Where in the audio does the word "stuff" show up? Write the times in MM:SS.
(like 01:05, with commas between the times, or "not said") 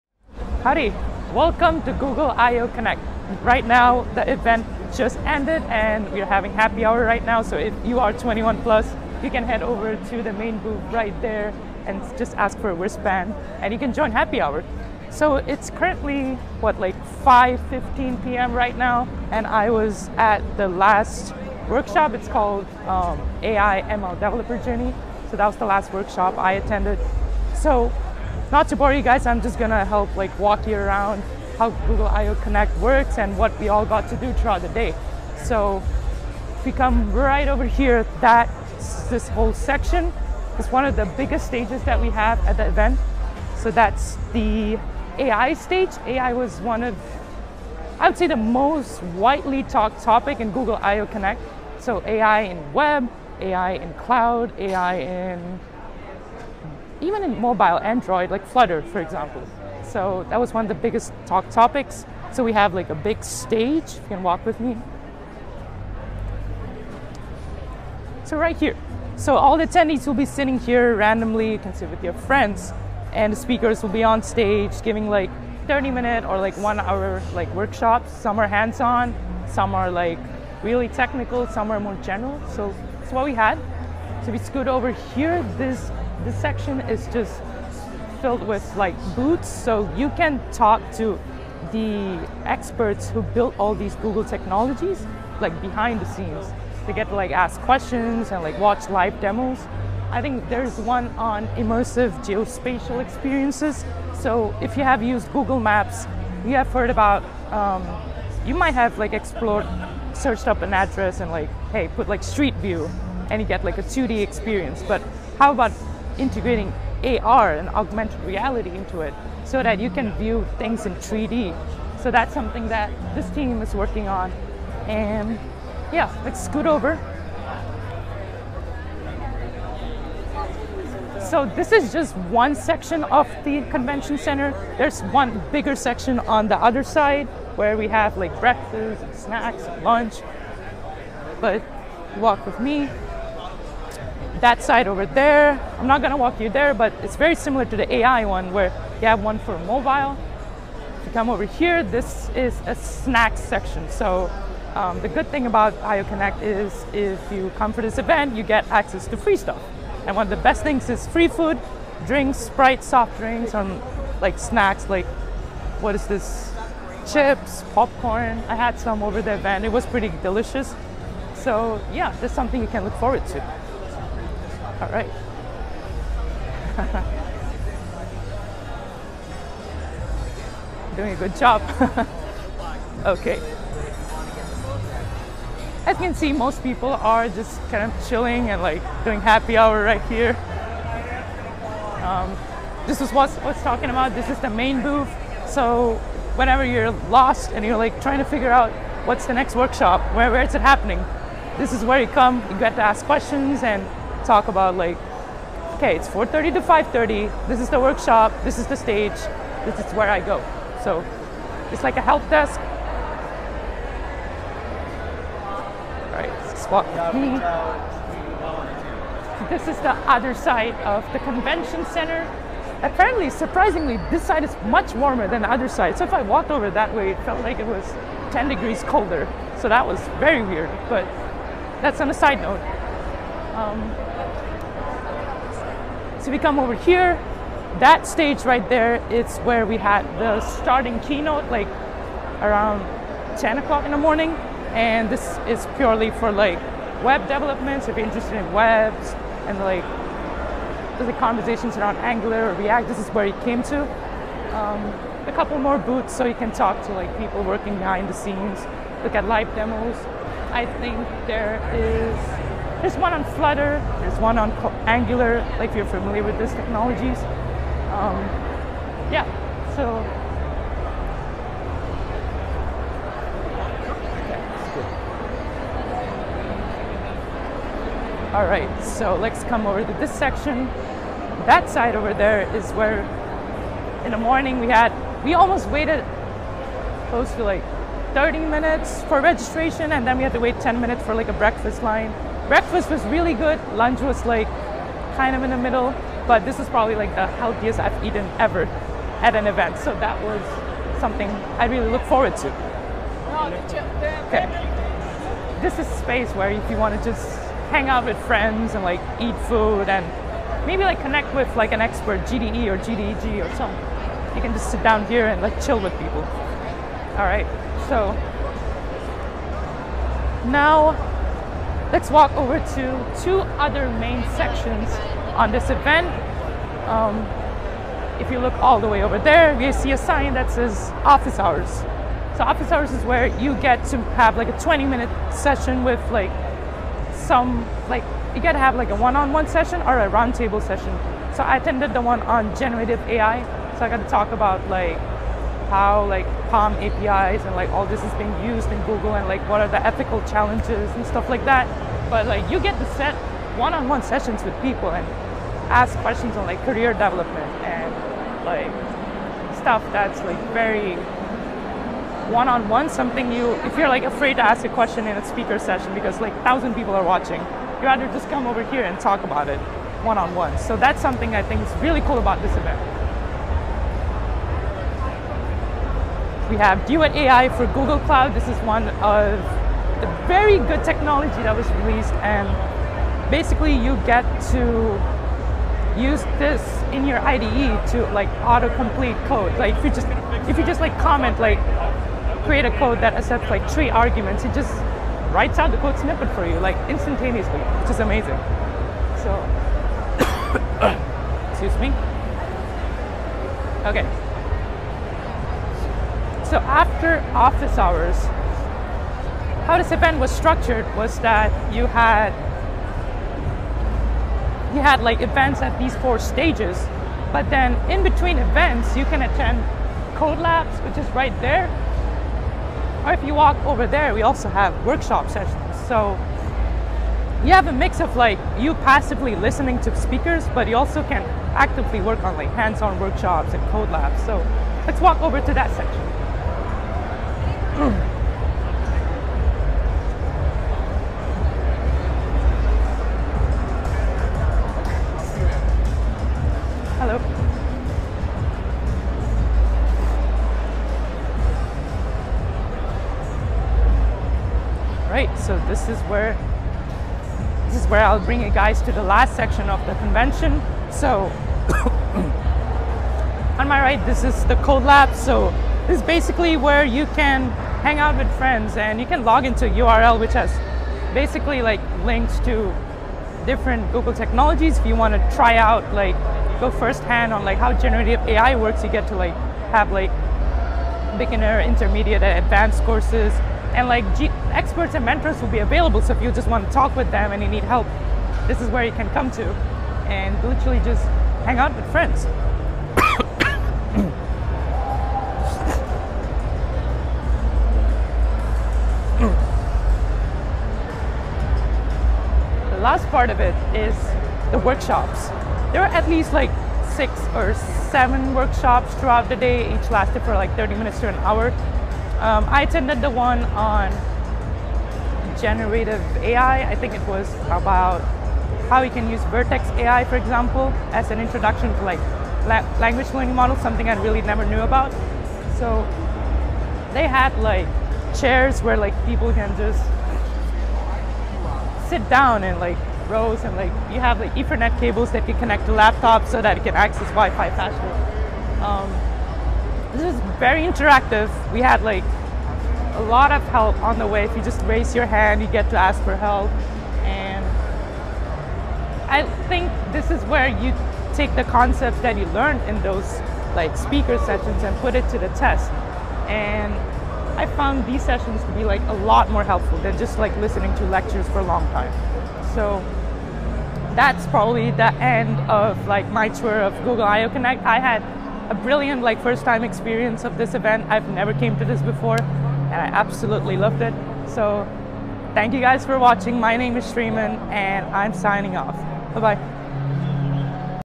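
02:39, 05:51, 05:59.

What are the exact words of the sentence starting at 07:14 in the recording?
So let's walk over to that section.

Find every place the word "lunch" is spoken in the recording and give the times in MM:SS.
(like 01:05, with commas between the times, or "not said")
02:19, 04:53.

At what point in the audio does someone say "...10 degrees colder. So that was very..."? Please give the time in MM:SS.
03:48.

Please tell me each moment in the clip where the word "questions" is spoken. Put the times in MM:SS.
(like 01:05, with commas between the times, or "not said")
01:37, 03:23, 05:55, 06:04.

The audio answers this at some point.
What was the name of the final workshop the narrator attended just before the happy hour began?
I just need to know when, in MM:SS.
00:23.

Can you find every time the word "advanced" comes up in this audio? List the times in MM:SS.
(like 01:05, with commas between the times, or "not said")
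08:02.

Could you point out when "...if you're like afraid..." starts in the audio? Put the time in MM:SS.
06:03.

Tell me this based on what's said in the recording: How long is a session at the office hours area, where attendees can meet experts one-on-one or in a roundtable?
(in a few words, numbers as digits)
20 minutes.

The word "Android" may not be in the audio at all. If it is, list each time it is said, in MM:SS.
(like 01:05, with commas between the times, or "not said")
00:57.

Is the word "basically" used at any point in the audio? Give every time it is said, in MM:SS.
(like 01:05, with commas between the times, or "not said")
06:23, 07:46, 07:51.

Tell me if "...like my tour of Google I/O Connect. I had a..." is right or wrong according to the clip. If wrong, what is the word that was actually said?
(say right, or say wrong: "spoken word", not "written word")
right.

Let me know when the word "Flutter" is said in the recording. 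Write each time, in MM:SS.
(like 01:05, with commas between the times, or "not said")
00:58, 04:23.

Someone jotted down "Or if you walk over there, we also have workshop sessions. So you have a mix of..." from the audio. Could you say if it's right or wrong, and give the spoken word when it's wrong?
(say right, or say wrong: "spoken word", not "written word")
right.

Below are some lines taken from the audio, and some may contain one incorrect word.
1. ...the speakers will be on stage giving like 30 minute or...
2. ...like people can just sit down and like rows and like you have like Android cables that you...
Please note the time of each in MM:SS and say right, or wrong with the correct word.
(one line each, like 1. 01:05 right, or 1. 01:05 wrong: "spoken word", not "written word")
1. 01:13 right
2. 08:48 wrong: "Ethernet", not "Android".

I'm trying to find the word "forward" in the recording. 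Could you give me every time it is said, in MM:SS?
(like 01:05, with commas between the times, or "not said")
02:52, 05:02.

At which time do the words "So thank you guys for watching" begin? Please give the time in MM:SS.
09:34.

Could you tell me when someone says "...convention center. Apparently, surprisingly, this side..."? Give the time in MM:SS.
03:41.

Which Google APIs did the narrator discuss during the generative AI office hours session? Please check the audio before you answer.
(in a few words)
PaLM.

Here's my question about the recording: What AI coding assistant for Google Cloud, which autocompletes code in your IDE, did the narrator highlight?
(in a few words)
Duet AI.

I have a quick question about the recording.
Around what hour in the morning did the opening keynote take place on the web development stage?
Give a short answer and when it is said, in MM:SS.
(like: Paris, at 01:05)
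10 o'clock, at 04:03.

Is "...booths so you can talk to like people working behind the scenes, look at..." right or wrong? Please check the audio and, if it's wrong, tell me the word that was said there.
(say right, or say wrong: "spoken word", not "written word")
right.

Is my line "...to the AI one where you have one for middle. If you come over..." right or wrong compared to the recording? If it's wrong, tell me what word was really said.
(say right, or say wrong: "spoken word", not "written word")
wrong: "mobile", not "middle".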